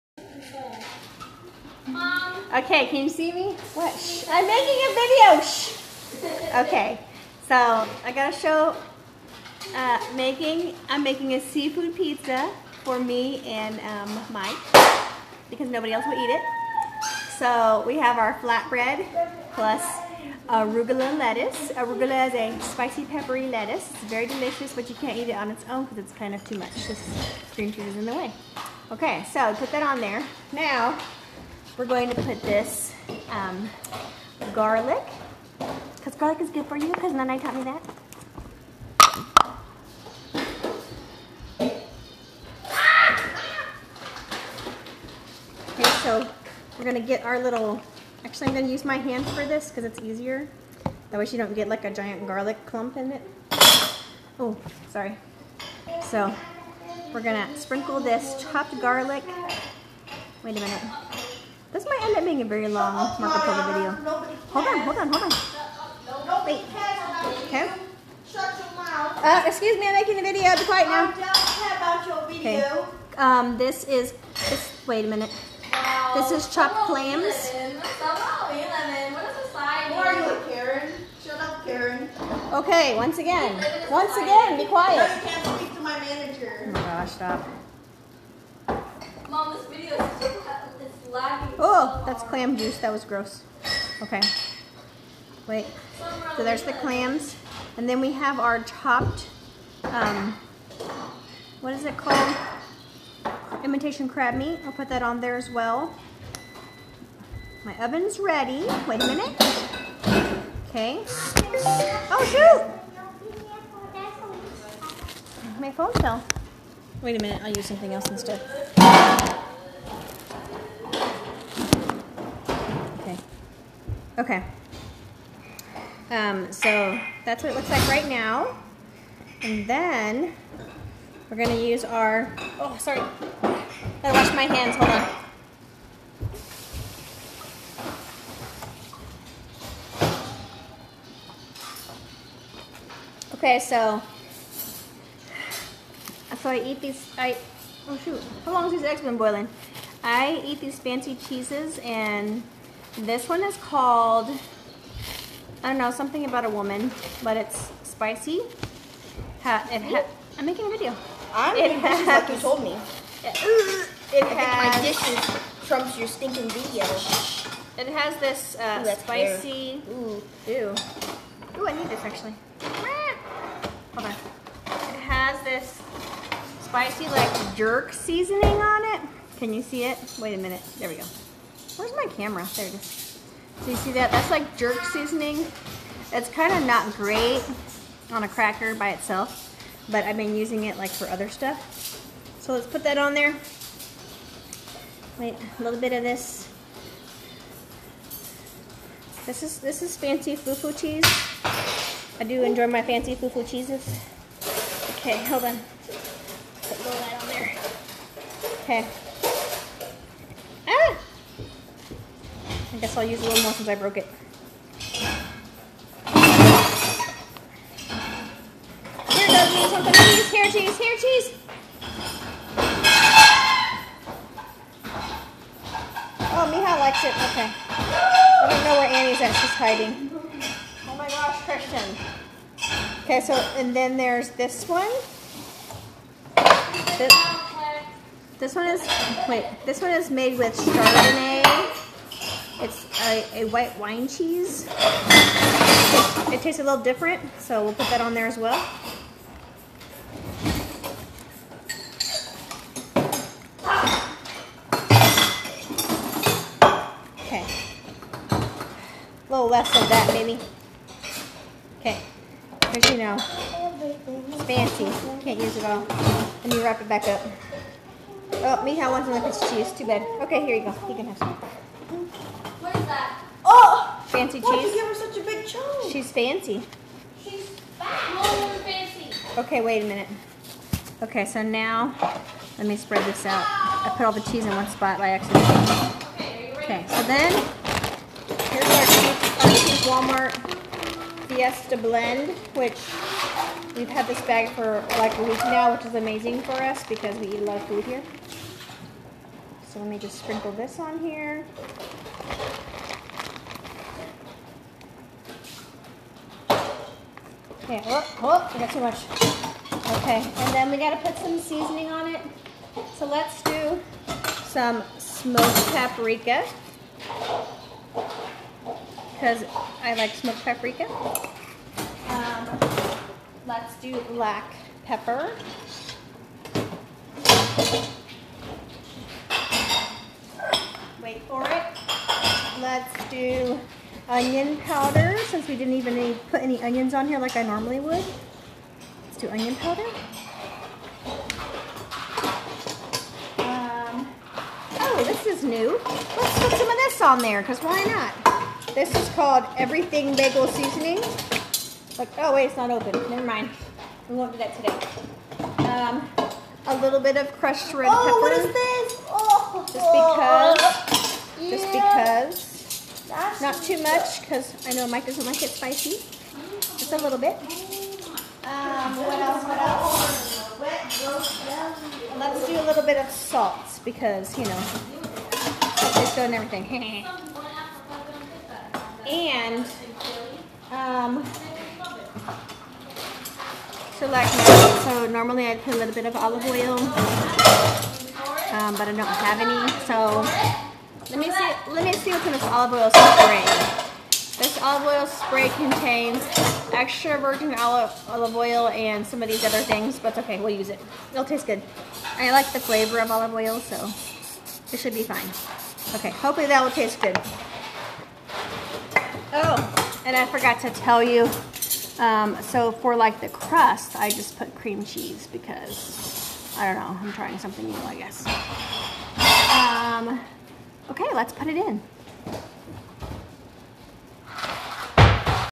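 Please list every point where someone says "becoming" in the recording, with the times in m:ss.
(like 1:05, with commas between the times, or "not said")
not said.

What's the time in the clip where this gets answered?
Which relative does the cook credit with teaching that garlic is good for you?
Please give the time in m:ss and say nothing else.
0:37.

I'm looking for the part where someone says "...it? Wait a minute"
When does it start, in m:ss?
2:59.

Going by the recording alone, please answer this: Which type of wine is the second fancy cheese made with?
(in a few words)
Chardonnay.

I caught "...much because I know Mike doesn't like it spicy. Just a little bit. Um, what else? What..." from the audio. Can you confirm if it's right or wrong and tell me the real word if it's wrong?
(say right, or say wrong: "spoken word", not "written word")
right.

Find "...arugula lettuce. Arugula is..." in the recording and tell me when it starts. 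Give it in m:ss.
0:20.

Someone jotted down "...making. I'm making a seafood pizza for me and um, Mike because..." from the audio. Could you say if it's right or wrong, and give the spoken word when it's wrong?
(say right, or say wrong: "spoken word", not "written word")
right.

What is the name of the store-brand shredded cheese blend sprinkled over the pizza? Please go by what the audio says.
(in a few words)
Walmart Fiesta blend.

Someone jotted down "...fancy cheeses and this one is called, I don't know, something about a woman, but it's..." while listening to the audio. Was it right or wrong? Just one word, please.
right.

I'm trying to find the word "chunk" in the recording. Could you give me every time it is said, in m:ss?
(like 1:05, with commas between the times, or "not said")
4:35.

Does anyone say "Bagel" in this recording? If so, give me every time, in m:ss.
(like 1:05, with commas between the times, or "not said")
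5:50.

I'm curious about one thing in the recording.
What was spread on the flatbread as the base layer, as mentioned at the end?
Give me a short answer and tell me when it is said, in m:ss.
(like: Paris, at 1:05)
Cream cheese, at 6:54.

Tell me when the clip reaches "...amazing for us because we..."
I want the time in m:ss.
4:55.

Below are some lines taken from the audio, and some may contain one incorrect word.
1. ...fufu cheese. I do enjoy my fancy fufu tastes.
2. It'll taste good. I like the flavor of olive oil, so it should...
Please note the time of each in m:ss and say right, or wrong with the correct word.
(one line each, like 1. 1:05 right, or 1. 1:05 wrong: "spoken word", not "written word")
1. 3:20 wrong: "cheeses", not "tastes"
2. 6:41 right.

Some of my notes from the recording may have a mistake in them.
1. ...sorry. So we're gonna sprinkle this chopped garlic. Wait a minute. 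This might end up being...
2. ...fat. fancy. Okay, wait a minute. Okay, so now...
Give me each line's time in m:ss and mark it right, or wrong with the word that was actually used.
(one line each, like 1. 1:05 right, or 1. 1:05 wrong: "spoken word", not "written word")
1. 0:54 right
2. 4:37 right.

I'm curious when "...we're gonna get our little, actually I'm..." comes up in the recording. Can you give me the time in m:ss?
0:46.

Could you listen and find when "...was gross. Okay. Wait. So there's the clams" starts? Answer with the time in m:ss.
1:32.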